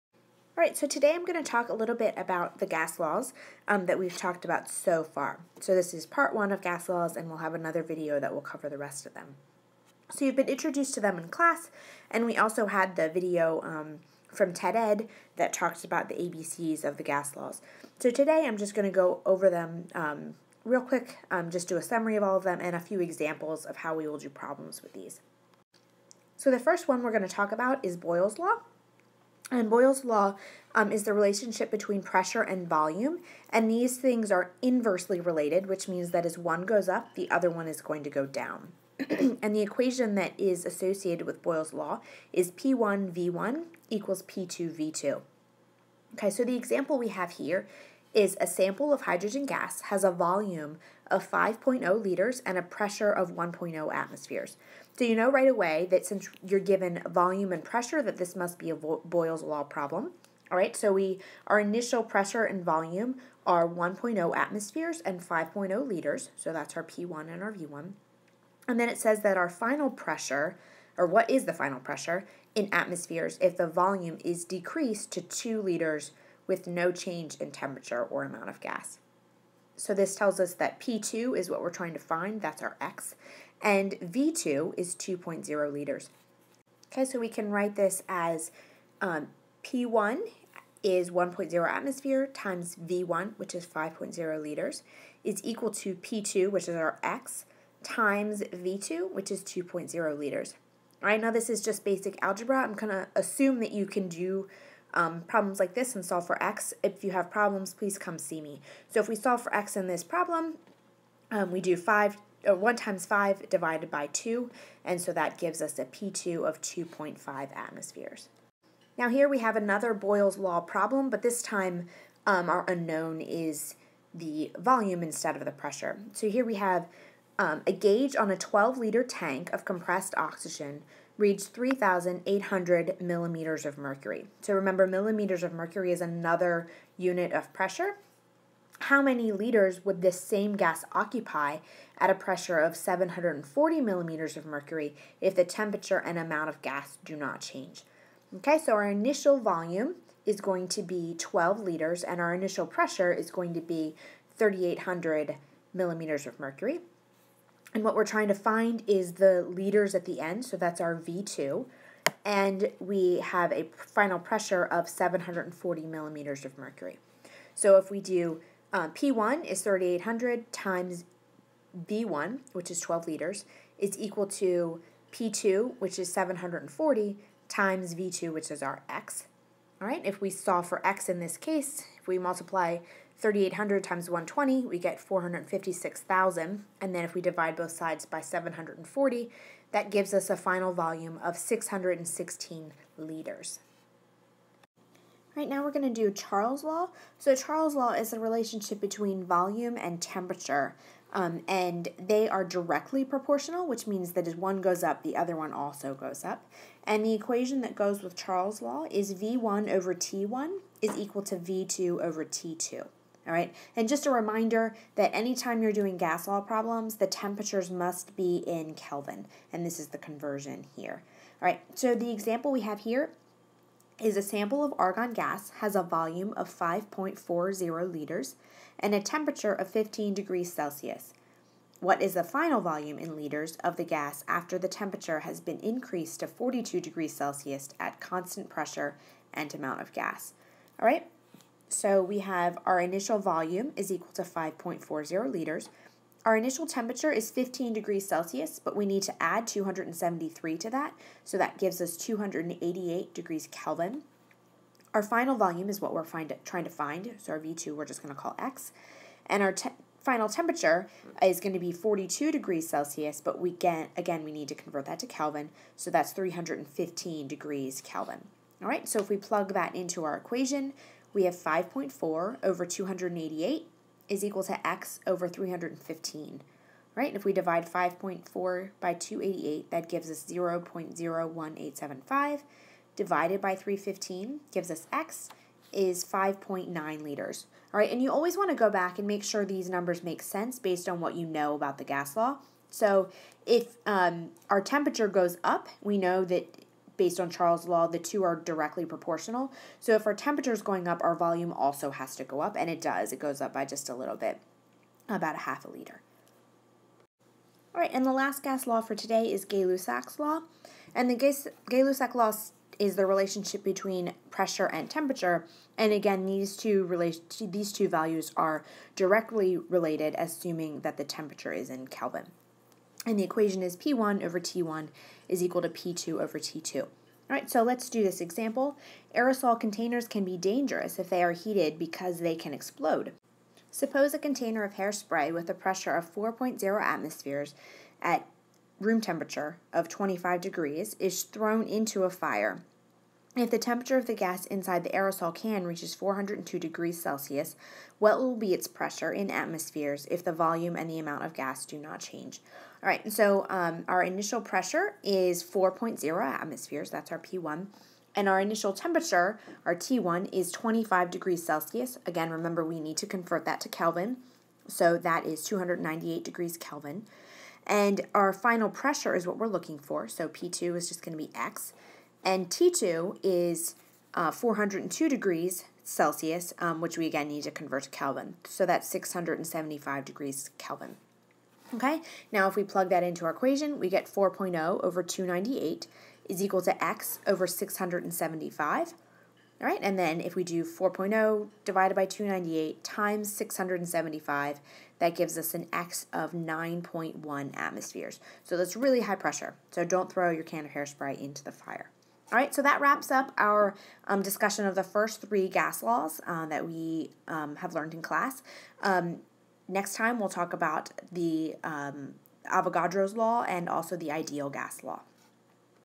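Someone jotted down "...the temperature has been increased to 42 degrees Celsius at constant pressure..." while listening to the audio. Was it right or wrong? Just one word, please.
right.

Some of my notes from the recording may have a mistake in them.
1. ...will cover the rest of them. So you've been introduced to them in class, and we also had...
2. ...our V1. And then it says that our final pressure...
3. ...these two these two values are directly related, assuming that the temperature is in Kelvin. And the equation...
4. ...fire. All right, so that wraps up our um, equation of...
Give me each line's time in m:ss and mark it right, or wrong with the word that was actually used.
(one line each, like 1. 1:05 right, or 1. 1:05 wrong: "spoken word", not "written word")
1. 0:08 right
2. 1:07 right
3. 5:16 right
4. 6:41 wrong: "discussion", not "equation".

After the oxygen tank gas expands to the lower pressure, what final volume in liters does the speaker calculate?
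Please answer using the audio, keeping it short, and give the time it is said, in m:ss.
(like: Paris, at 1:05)
616 liters, at 3:11.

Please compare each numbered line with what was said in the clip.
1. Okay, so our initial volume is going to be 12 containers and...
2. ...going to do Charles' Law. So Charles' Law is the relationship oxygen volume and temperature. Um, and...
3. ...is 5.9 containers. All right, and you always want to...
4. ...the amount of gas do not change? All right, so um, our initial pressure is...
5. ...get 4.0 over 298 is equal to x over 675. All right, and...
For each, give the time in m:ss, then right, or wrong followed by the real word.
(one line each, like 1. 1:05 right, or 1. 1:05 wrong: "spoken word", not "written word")
1. 2:28 wrong: "liters", not "containers"
2. 3:15 wrong: "between", not "oxygen"
3. 4:45 wrong: "liters", not "containers"
4. 5:50 right
5. 6:23 right.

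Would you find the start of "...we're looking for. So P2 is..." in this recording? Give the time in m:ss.
6:09.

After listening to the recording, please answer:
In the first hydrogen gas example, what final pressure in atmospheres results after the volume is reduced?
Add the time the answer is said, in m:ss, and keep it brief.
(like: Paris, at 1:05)
2.5 atmospheres, at 1:56.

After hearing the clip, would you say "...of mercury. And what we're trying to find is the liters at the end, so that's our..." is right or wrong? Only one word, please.
right.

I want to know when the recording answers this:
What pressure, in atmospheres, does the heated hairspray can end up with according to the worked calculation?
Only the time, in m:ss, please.
6:36.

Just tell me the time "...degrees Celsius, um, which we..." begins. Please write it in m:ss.
6:15.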